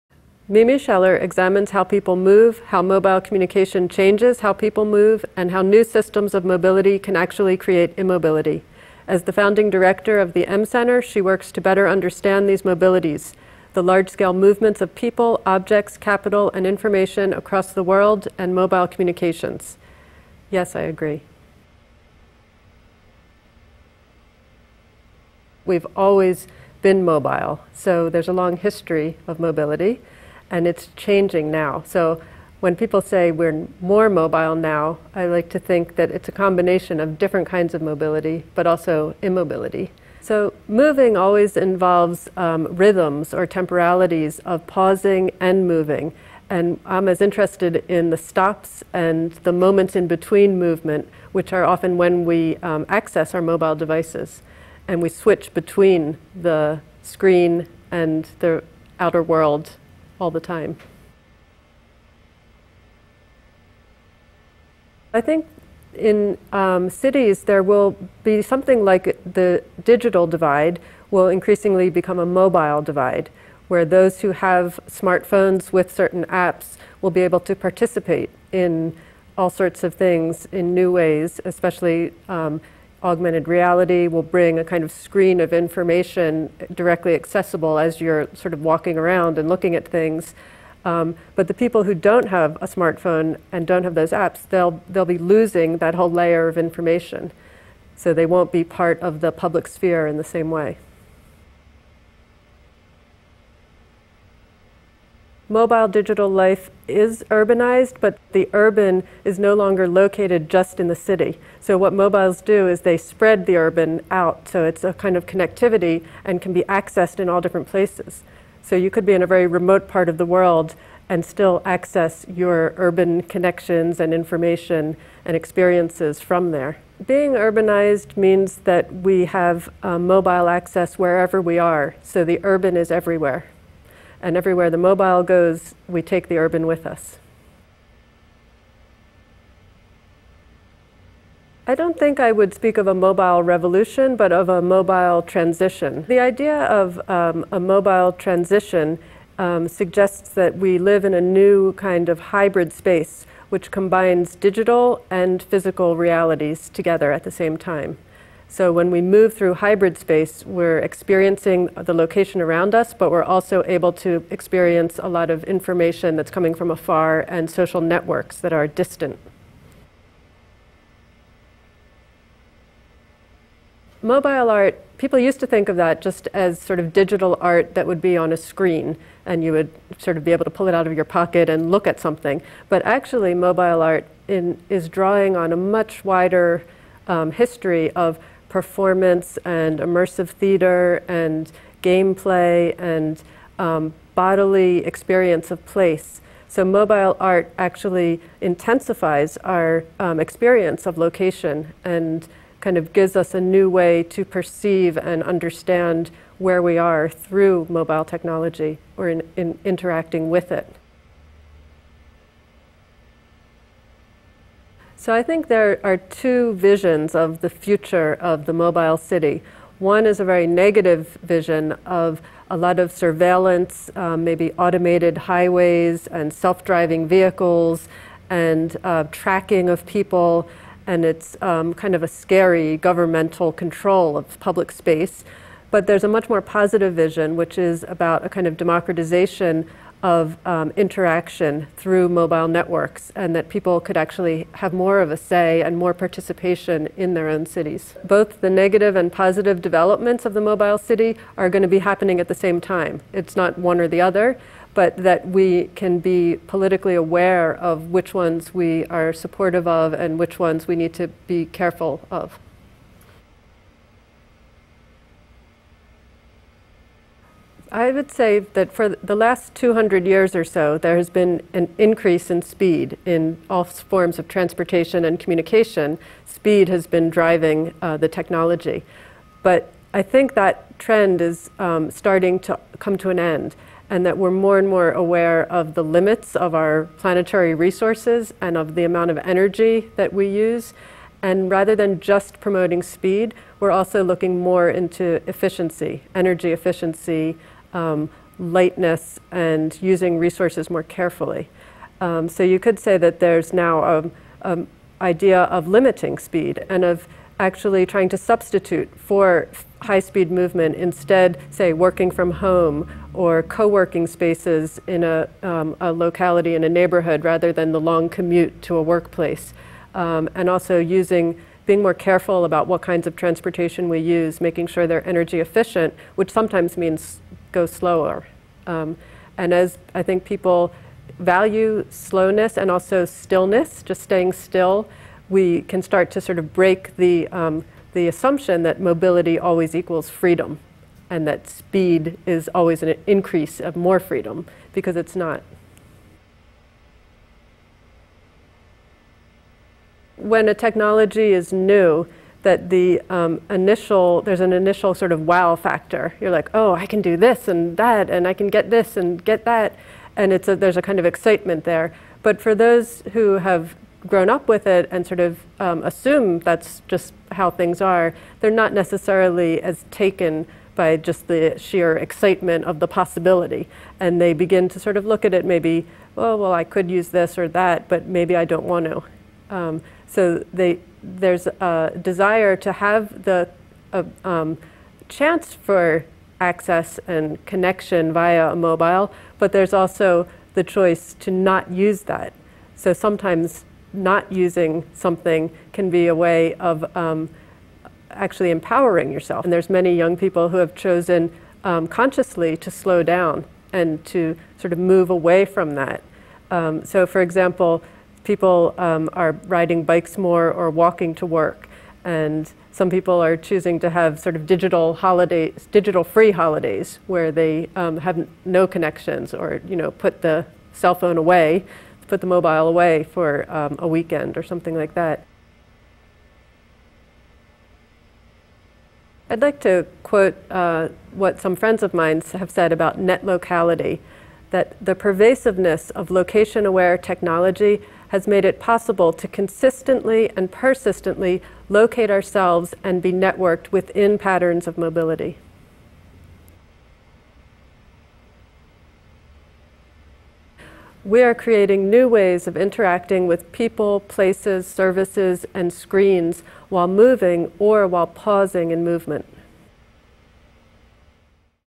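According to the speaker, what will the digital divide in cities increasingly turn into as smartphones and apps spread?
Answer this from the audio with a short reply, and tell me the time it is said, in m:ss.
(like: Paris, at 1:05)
mobile divide, at 1:12.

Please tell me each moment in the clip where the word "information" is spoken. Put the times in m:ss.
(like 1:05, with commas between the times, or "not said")
0:16, 1:25, 1:36, 2:04, 2:45.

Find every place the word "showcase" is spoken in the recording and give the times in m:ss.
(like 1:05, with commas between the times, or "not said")
not said.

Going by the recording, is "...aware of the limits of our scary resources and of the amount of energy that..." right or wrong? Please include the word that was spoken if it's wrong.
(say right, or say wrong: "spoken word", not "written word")
wrong: "planetary", not "scary".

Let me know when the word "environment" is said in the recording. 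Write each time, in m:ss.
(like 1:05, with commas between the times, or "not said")
not said.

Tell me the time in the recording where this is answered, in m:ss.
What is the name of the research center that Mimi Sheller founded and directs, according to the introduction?
0:10.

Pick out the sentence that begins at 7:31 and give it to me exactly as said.
We are creating new ways of interacting with people, places, services, and screens while moving or while pausing in movement.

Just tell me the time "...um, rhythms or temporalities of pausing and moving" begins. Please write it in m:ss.
0:42.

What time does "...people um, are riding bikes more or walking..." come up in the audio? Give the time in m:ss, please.
6:48.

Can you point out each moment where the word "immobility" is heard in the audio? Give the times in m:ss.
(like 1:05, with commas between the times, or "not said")
0:07, 0:39.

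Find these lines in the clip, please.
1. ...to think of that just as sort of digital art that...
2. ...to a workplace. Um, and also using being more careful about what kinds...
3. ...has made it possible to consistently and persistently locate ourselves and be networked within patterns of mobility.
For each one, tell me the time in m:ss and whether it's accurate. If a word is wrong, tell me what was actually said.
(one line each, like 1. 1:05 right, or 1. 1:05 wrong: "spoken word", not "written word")
1. 2:55 right
2. 5:18 right
3. 7:18 right.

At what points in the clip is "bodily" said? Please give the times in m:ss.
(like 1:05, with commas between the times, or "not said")
3:14.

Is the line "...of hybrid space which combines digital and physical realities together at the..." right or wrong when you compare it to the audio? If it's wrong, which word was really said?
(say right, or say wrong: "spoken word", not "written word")
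right.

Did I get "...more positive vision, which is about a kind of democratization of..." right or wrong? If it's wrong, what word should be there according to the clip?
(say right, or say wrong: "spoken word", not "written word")
right.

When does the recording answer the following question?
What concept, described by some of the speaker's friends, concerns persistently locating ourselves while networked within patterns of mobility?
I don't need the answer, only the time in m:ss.
7:12.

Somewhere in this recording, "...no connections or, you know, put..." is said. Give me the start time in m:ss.
6:58.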